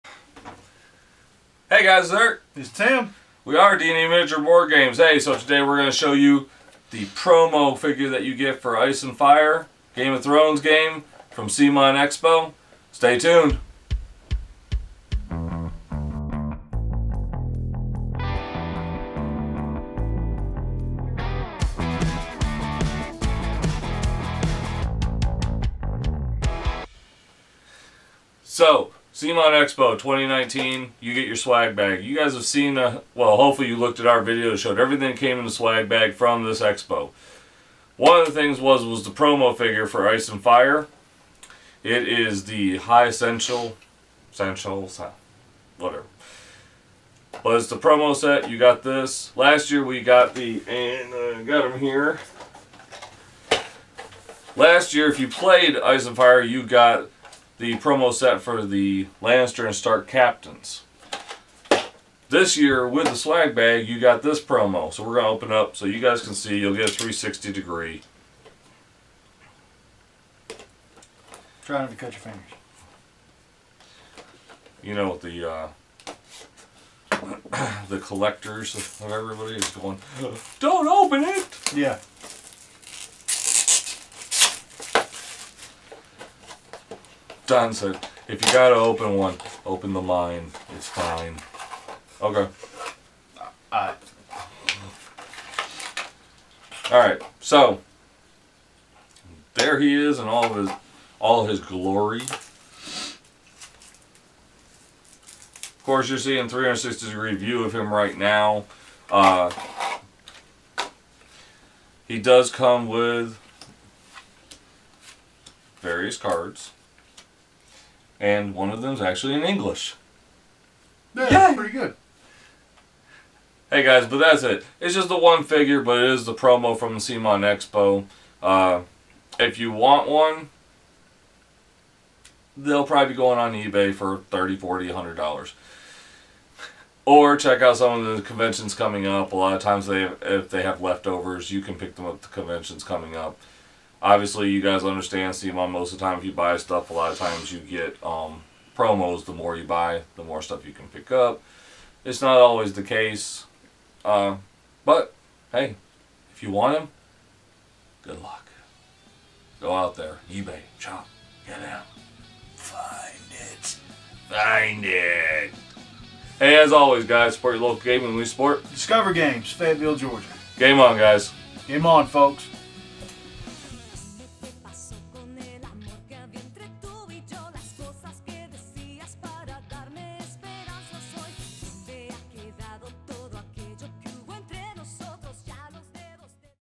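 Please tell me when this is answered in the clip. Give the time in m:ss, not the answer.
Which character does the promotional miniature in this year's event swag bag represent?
0:42.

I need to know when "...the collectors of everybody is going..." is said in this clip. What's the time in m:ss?
1:17.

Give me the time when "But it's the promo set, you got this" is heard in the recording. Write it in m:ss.
0:47.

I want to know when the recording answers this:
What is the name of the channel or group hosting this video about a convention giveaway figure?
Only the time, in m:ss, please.
0:03.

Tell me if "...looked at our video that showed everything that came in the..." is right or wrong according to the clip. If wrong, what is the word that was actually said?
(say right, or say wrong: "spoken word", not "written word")
right.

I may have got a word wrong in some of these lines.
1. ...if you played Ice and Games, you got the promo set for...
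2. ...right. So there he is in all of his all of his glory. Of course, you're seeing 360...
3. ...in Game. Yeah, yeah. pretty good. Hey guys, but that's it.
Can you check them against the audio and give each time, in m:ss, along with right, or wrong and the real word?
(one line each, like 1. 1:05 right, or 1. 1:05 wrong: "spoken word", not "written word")
1. 0:55 wrong: "Fire", not "Games"
2. 1:36 right
3. 1:59 wrong: "English", not "Game".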